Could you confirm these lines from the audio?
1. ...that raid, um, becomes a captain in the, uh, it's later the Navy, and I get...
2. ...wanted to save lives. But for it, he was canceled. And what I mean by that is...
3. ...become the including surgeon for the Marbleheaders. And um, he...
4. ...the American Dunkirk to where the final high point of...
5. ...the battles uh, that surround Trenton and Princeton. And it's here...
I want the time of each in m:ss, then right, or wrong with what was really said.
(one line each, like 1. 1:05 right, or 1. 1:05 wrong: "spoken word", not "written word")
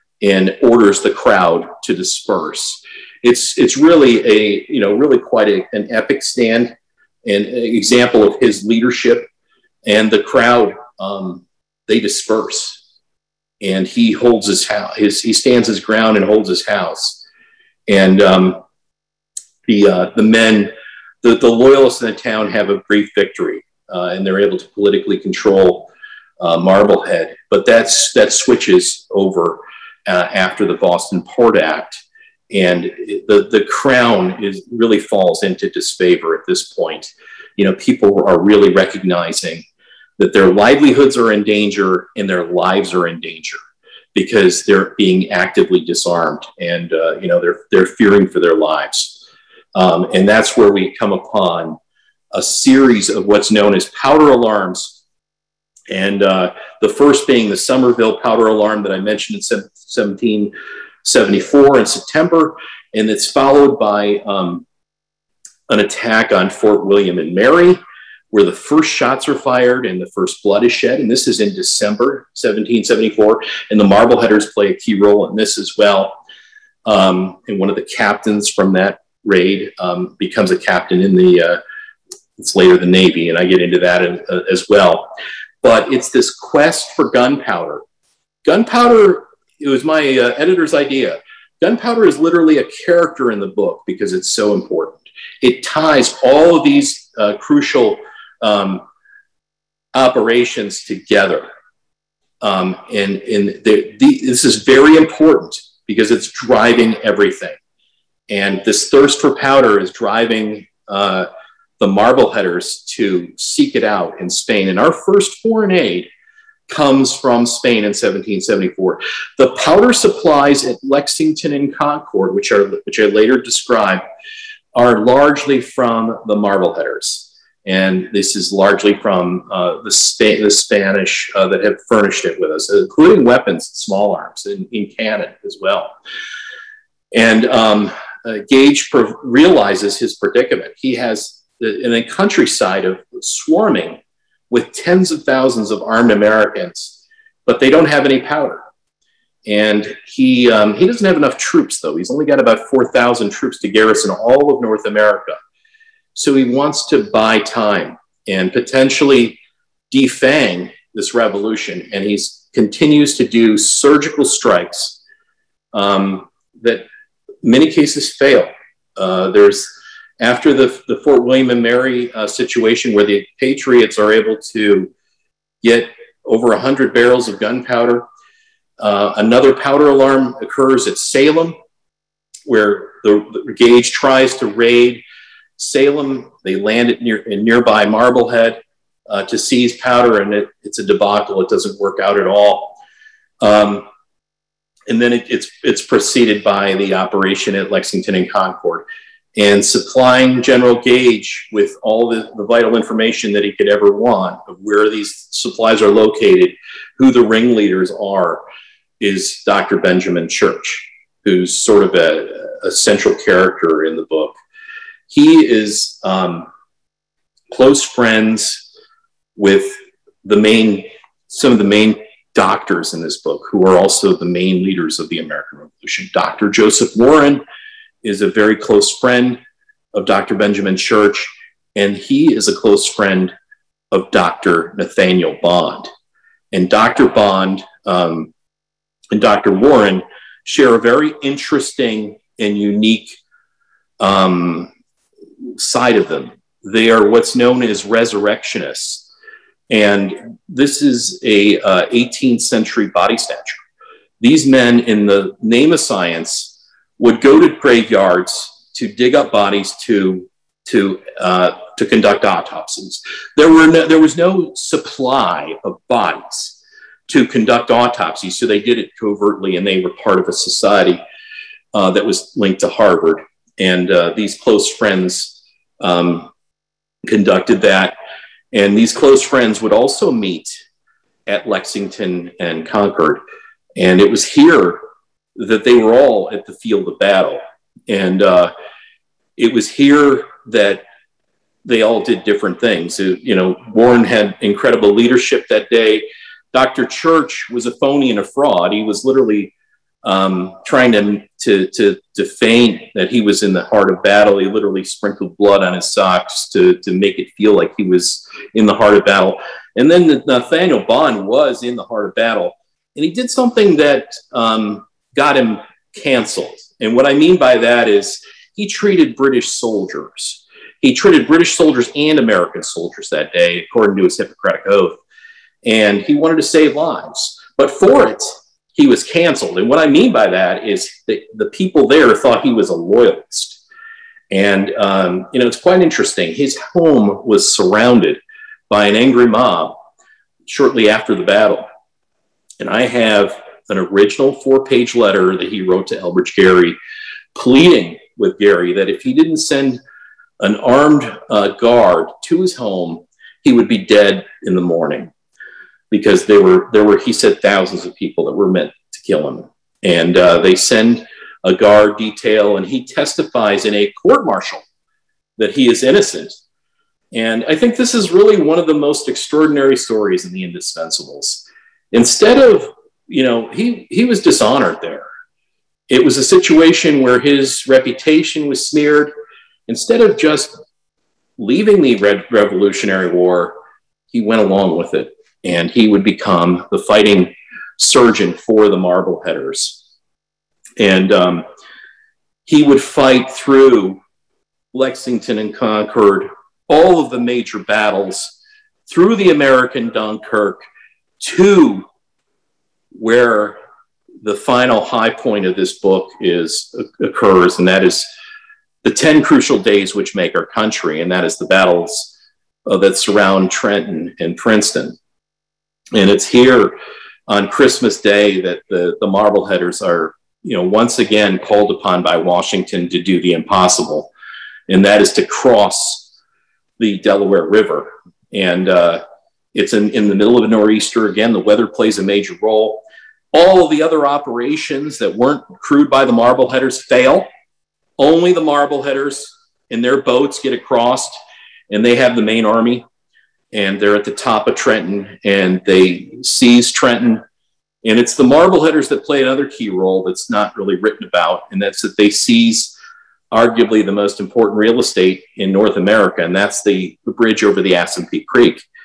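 1. 1:18 right
2. 5:26 right
3. 6:26 wrong: "fighting", not "including"
4. 6:39 right
5. 6:51 right.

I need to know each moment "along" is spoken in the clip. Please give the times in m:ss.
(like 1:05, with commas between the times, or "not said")
6:24.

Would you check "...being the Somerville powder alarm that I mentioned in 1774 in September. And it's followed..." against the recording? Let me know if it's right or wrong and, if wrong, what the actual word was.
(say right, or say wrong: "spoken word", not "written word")
right.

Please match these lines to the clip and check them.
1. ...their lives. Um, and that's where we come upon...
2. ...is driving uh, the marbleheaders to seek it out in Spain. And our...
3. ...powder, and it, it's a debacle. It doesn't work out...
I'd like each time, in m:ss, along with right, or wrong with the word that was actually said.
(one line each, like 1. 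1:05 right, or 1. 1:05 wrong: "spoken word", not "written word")
1. 0:48 right
2. 1:49 right
3. 3:09 right.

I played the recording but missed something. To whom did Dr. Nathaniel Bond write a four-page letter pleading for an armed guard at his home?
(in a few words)
Elbridge Gerry.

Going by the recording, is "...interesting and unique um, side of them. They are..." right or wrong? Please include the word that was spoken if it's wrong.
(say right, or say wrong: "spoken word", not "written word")
right.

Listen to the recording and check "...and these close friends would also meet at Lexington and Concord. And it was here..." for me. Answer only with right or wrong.
right.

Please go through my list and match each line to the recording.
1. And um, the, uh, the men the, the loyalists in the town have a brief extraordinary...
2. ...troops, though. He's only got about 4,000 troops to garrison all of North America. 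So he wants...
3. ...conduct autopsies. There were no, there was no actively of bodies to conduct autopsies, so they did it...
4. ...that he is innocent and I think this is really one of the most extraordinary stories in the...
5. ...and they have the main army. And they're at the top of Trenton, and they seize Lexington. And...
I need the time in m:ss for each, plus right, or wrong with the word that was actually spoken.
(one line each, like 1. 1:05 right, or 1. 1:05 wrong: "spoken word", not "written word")
1. 0:17 wrong: "victory", not "extraordinary"
2. 2:31 right
3. 4:21 wrong: "supply", not "actively"
4. 6:05 right
5. 7:21 wrong: "Trenton", not "Lexington".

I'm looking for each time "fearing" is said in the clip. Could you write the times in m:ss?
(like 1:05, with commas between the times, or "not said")
0:47.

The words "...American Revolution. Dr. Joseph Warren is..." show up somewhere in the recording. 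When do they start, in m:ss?
3:45.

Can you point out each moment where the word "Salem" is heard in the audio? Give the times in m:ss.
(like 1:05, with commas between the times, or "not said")
3:00, 3:05.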